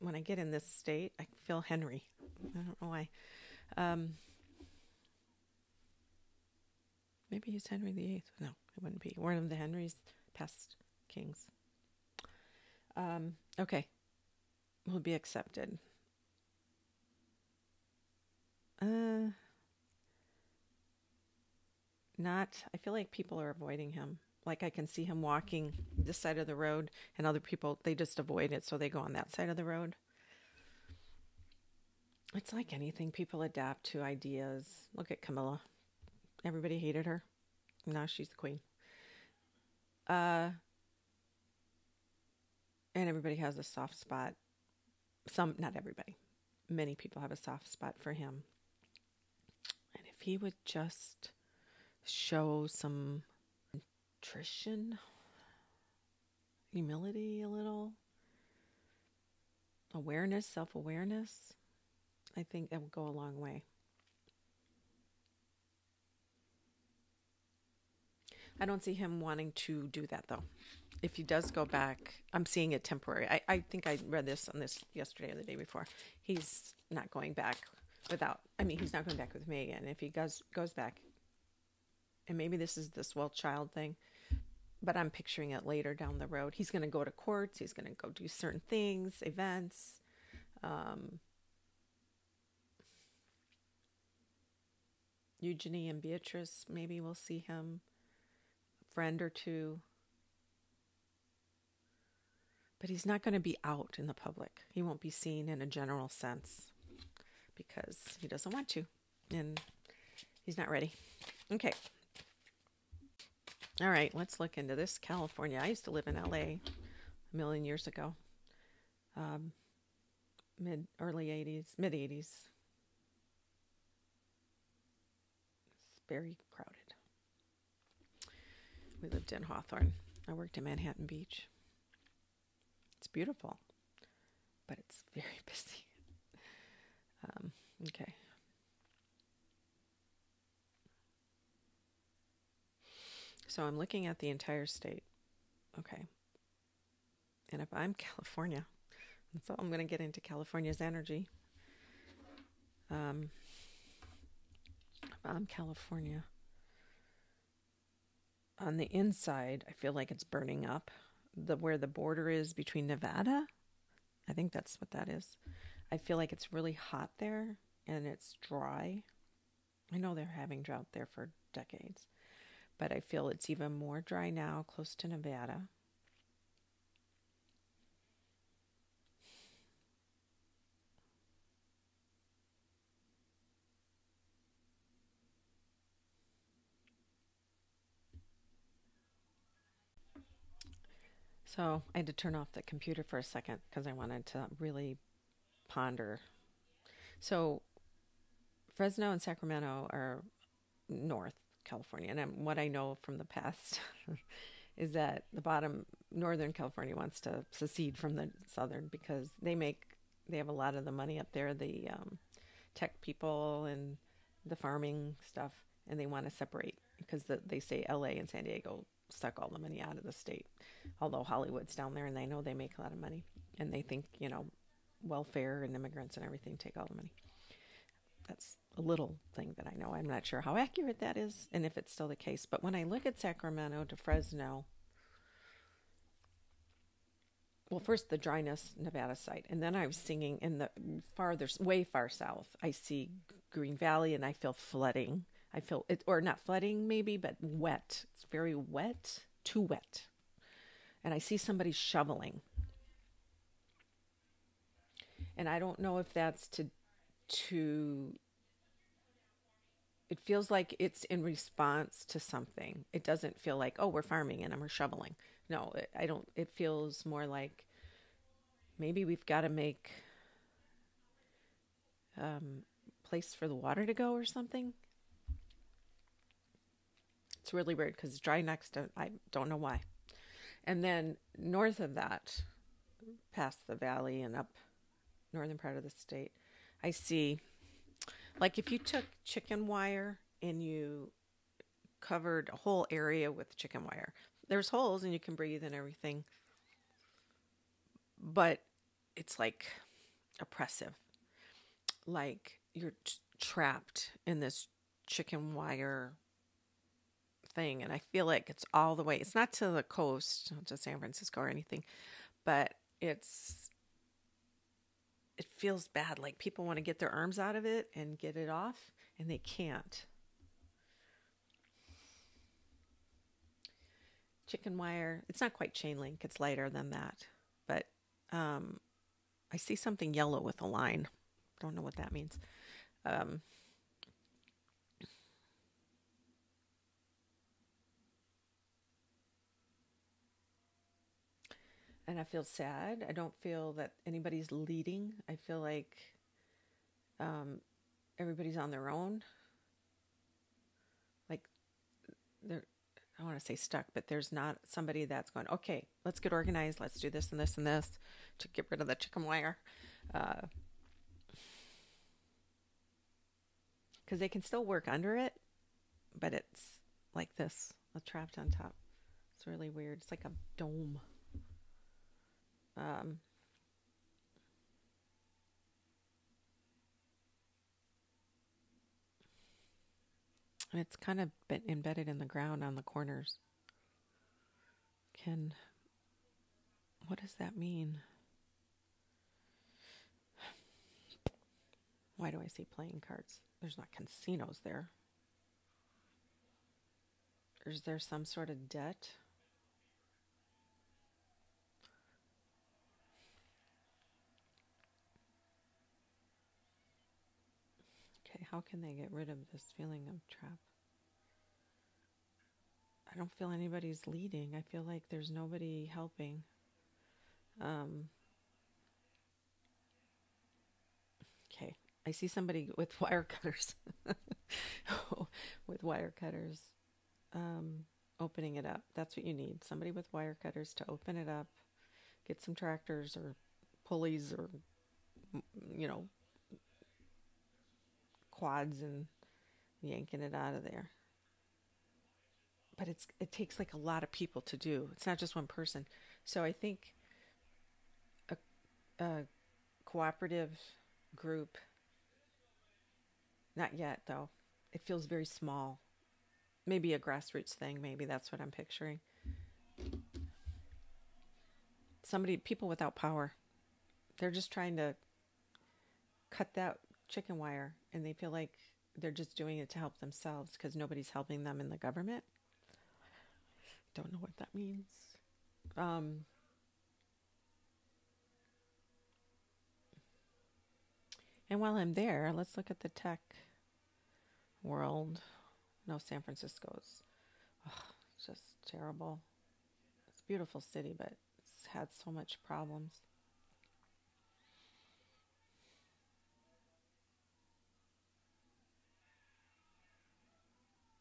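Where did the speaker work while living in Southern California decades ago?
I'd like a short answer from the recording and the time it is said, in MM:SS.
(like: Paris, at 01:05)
Manhattan Beach, at 02:10.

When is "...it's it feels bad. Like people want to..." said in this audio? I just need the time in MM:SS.
05:13.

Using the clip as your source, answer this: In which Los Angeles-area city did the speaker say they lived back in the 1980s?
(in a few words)
Hawthorne.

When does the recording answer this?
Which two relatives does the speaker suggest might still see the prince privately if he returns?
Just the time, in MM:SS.
01:35.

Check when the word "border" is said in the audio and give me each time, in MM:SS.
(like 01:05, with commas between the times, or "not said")
02:41.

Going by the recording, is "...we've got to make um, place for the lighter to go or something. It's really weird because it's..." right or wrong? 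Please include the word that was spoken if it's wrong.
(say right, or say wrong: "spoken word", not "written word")
wrong: "water", not "lighter".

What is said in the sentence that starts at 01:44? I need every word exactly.
He won't be seen in a general sense because he doesn't want to and he's not ready.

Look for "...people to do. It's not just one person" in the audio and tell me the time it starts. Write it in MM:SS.
07:24.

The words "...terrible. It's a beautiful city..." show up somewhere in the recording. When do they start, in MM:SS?
08:08.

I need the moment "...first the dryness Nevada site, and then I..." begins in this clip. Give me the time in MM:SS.
03:57.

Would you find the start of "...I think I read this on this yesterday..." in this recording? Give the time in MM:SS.
01:13.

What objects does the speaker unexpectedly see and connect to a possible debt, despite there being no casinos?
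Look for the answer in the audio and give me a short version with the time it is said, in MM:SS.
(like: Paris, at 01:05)
Playing cards, at 06:32.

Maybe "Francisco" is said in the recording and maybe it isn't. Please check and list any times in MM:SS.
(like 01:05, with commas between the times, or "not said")
05:10, 08:06.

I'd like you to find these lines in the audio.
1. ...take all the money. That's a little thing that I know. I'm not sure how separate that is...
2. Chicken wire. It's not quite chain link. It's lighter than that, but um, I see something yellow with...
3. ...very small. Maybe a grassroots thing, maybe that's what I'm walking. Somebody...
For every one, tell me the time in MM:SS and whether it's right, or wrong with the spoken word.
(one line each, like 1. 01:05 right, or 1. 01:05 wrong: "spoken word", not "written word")
1. 03:46 wrong: "accurate", not "separate"
2. 05:24 right
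3. 07:35 wrong: "picturing", not "walking".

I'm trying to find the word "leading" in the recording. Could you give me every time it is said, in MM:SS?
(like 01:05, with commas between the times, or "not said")
05:44, 06:54.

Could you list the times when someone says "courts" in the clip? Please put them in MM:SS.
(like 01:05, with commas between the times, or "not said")
01:27.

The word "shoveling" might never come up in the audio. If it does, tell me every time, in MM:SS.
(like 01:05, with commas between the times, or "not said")
04:11, 04:24.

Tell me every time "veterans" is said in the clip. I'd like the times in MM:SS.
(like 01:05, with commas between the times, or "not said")
not said.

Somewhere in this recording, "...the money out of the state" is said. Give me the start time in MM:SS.
03:39.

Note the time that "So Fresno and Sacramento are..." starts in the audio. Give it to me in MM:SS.
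03:17.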